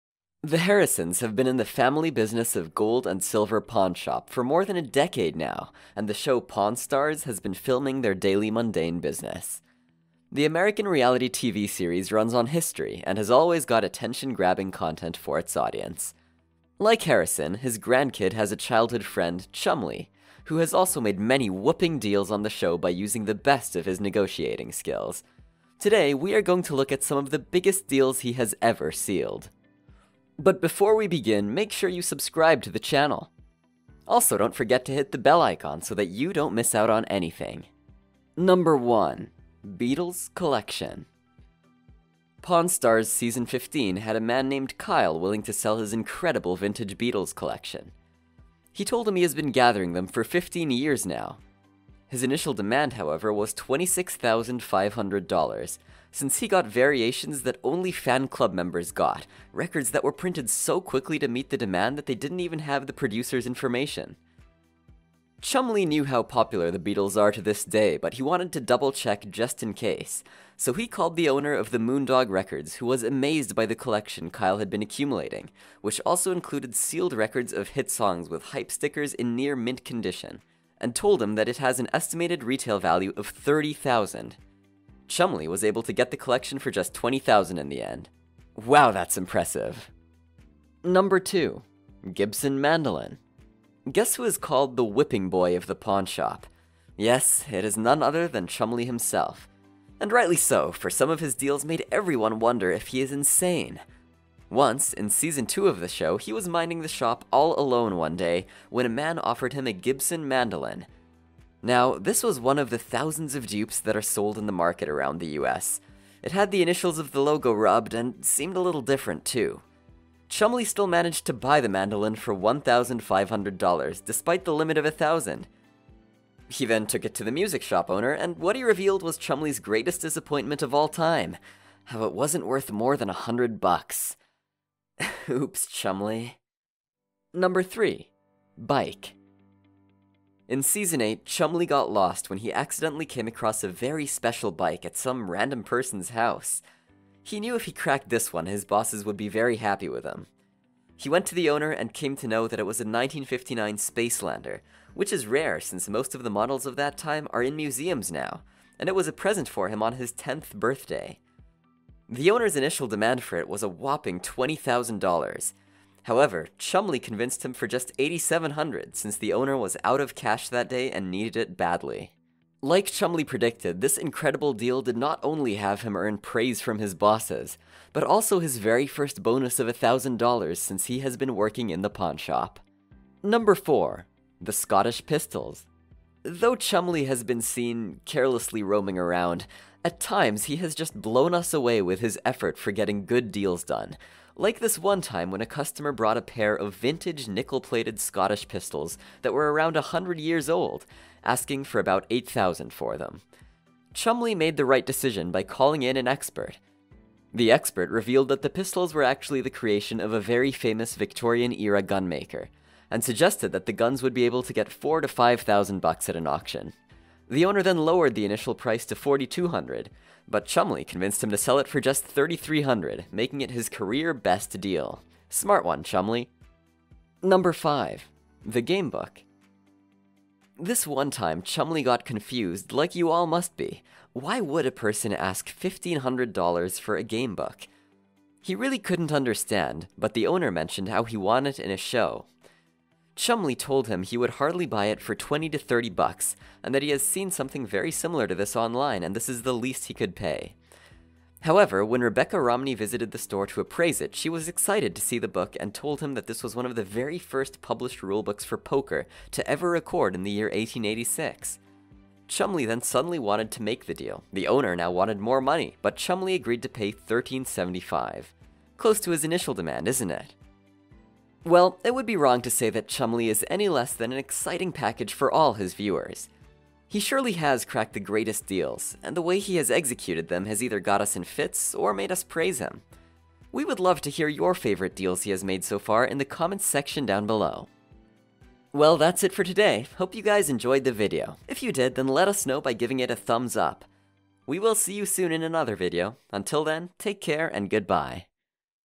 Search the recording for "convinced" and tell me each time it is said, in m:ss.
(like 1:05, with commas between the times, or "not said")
2:47, 3:40.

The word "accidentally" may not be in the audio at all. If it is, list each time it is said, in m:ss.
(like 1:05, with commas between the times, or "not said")
2:22.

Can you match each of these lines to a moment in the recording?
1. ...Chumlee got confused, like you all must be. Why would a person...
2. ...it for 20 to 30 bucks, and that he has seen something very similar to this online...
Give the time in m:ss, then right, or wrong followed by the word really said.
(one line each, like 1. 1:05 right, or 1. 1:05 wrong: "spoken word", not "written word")
1. 3:51 right
2. 4:04 right.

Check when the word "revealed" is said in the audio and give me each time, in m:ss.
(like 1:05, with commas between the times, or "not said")
2:08, 3:27.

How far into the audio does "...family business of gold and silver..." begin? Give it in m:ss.
0:01.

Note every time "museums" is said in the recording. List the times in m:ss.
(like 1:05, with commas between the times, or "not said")
2:37.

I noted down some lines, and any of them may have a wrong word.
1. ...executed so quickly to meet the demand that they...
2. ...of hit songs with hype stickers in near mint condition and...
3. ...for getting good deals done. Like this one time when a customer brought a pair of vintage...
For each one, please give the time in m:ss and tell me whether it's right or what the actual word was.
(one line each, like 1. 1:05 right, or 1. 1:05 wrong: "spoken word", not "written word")
1. 1:00 wrong: "printed", not "executed"
2. 1:17 right
3. 3:12 right.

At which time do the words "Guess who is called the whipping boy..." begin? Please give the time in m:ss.
1:33.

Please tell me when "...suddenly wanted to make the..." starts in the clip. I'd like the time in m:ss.
4:22.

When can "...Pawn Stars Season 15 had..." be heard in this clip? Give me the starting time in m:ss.
0:42.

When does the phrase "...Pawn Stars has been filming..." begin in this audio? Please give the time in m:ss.
0:06.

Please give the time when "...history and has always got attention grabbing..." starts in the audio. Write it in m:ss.
0:12.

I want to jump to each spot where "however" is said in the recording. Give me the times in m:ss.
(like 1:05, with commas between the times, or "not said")
0:52, 2:46, 4:11.